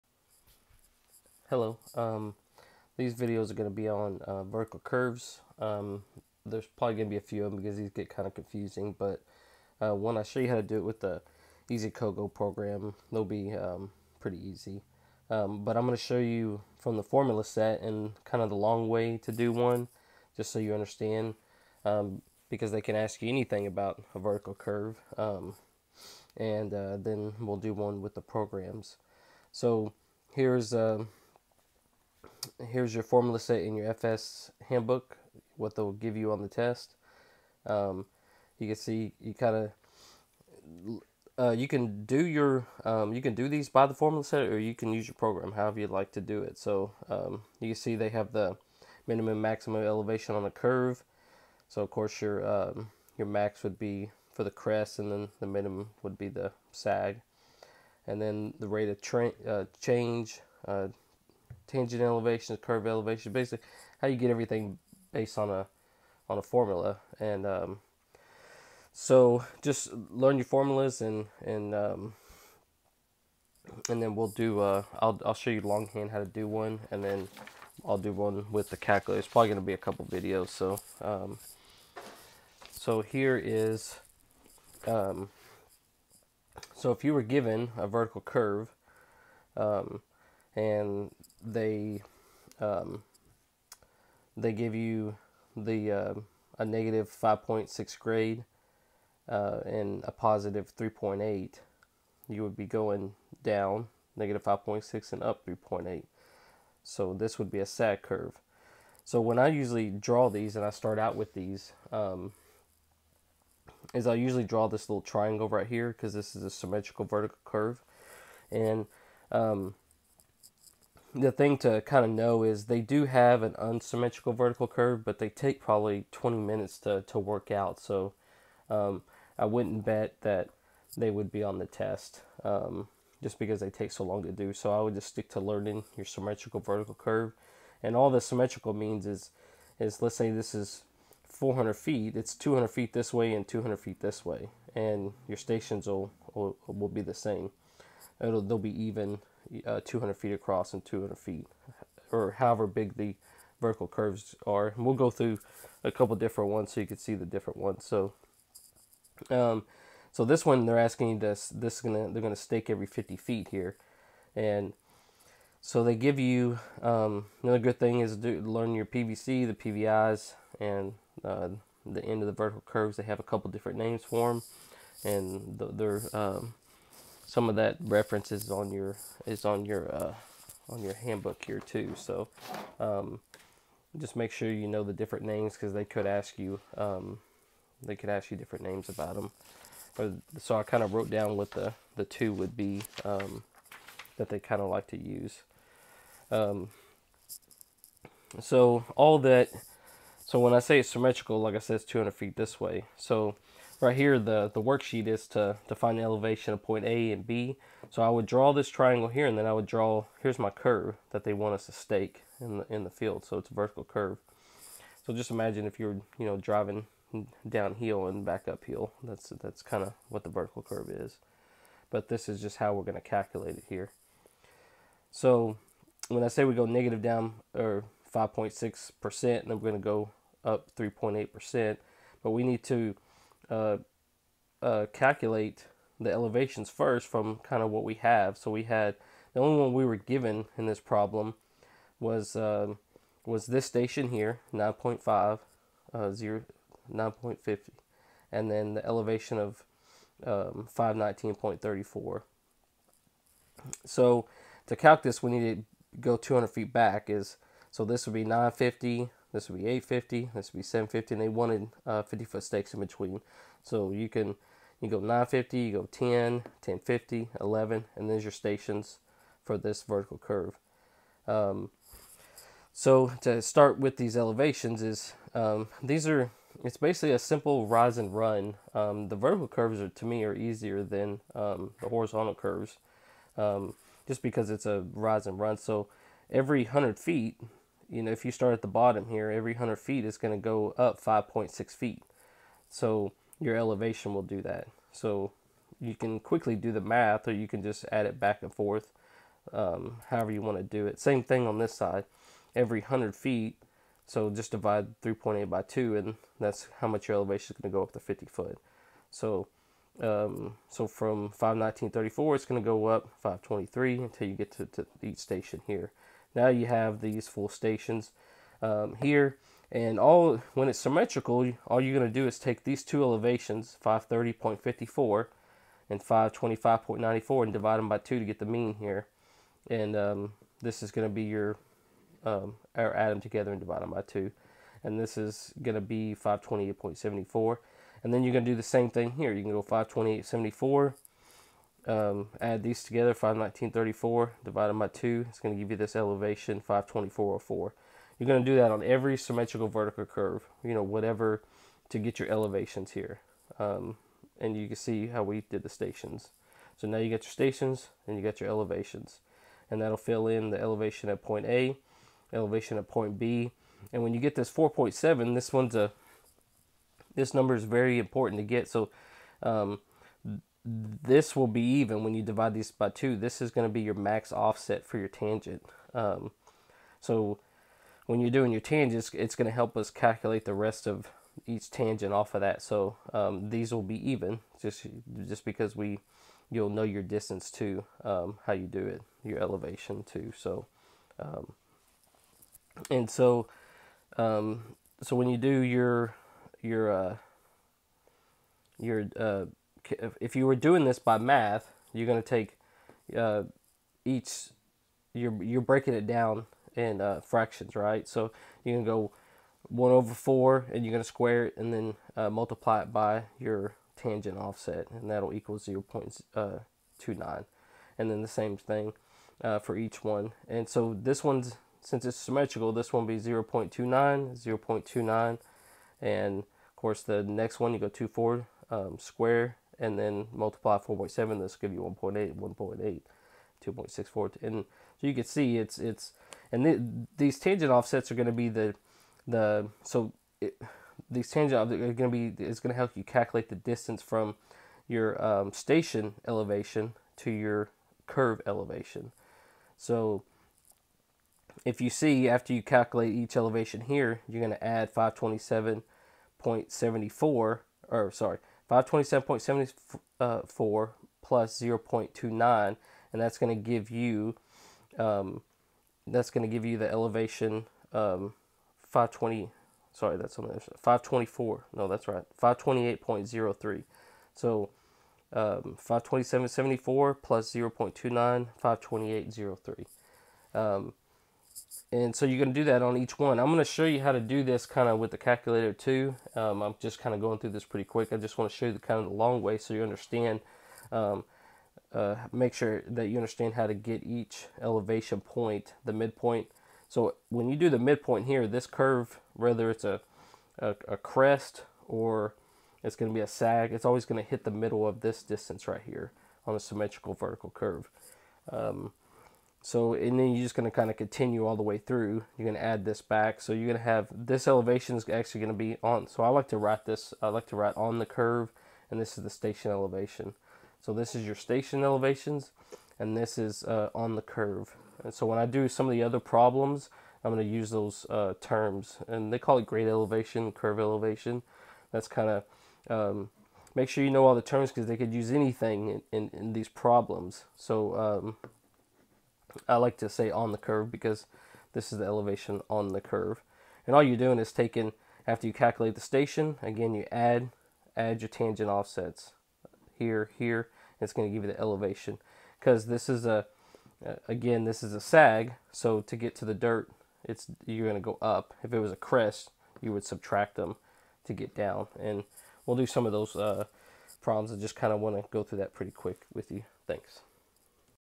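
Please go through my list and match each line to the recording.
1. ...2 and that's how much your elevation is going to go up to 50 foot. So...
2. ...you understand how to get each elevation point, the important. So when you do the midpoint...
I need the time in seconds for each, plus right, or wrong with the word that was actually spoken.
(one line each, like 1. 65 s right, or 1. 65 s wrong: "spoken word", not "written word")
1. 305 s right
2. 493 s wrong: "midpoint", not "important".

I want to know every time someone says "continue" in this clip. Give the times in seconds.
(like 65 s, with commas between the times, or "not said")
510 s.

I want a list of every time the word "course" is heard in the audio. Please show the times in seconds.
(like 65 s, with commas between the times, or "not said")
51 s, 426 s.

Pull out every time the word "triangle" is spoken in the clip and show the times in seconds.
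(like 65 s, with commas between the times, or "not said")
115 s, 208 s.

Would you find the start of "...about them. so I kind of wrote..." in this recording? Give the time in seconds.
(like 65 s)
188 s.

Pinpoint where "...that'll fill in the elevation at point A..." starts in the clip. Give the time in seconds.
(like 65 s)
359 s.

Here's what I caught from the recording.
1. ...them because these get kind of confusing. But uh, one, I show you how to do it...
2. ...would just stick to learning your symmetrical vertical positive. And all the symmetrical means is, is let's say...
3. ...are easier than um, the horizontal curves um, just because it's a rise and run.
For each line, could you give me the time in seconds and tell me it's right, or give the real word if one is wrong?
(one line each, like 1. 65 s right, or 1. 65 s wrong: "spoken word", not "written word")
1. 7 s right
2. 134 s wrong: "curve", not "positive"
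3. 280 s right.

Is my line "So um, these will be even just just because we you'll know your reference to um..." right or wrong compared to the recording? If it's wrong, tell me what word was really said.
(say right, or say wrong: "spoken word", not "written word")
wrong: "distance", not "reference".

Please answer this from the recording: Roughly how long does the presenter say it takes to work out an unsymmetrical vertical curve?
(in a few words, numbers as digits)
20 minutes.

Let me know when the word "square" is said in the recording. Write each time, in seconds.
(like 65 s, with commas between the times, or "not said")
411 s, 428 s.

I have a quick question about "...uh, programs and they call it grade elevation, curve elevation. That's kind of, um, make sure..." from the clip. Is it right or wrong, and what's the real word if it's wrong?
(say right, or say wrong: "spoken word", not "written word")
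wrong: "terms", not "programs".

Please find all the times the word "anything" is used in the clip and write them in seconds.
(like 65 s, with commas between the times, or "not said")
23 s, 535 s.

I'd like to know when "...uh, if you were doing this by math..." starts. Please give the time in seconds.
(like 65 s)
399 s.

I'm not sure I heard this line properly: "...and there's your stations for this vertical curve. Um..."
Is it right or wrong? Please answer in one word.
right.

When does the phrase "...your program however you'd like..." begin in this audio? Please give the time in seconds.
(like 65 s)
45 s.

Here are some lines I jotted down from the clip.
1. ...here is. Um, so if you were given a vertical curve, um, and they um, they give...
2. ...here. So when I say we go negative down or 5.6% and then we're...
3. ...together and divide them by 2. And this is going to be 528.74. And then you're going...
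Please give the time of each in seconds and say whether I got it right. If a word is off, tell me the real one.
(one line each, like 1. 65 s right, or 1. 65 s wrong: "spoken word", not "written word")
1. 83 s right
2. 223 s right
3. 333 s right.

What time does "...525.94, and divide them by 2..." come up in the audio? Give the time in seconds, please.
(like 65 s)
326 s.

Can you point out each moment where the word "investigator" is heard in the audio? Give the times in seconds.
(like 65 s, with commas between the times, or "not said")
not said.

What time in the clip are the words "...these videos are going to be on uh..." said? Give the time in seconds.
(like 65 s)
2 s.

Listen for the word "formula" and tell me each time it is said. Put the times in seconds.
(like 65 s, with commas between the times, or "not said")
17 s, 33 s, 43 s, 66 s, 70 s.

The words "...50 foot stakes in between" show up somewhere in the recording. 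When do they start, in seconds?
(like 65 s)
262 s.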